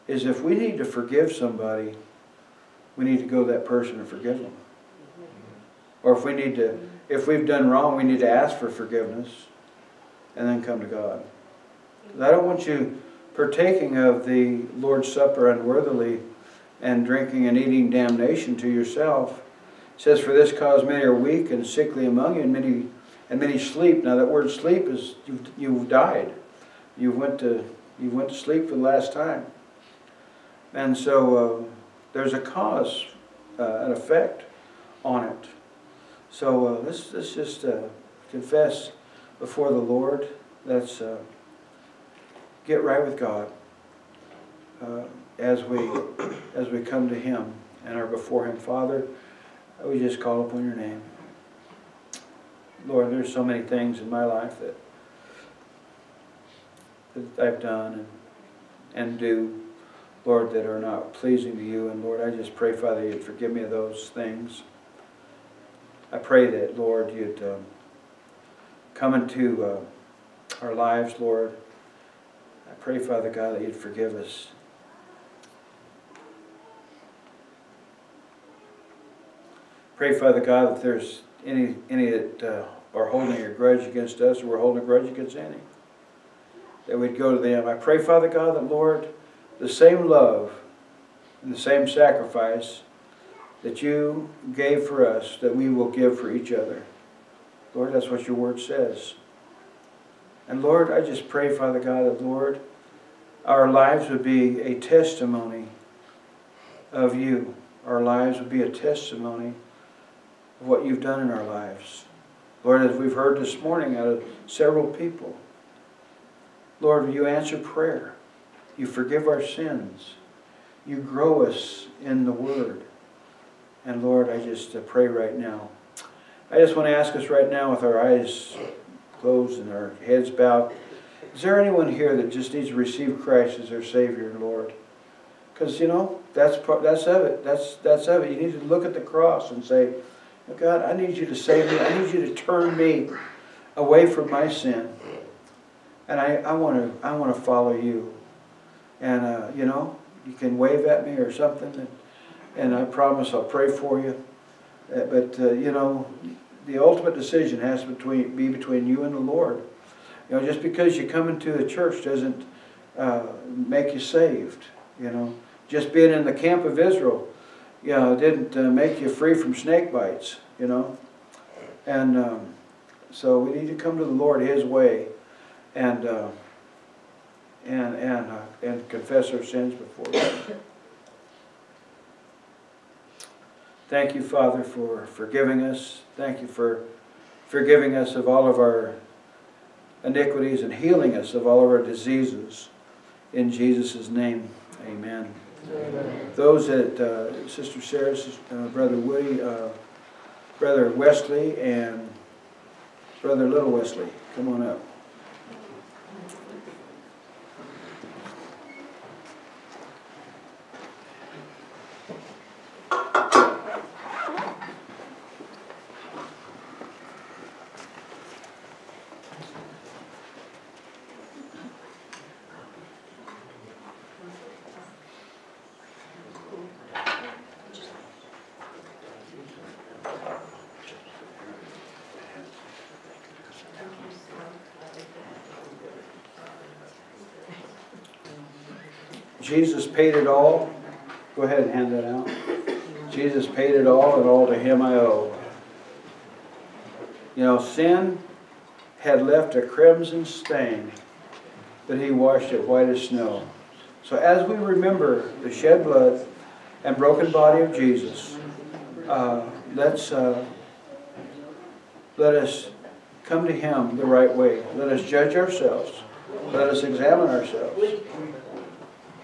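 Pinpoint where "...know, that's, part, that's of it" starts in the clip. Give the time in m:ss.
2:15.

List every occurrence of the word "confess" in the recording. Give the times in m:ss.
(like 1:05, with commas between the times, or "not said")
0:38, 2:58.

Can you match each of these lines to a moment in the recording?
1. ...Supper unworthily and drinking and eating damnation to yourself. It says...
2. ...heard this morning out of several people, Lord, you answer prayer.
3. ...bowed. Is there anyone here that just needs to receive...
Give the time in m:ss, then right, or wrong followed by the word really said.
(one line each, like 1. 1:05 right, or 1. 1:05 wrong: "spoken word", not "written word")
1. 0:15 right
2. 1:53 right
3. 2:10 right.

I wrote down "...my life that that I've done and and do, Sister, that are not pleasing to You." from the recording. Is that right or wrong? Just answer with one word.
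wrong.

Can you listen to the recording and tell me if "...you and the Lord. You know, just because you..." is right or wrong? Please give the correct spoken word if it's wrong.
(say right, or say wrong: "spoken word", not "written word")
right.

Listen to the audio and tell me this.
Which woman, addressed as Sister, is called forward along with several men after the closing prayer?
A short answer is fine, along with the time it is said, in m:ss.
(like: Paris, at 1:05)
Sarah, at 3:17.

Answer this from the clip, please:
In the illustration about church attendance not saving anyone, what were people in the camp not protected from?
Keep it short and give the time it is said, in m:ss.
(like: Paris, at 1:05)
Snake bites, at 2:49.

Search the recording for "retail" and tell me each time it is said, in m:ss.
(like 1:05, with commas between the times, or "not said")
not said.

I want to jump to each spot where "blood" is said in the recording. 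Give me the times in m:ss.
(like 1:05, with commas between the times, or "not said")
4:15.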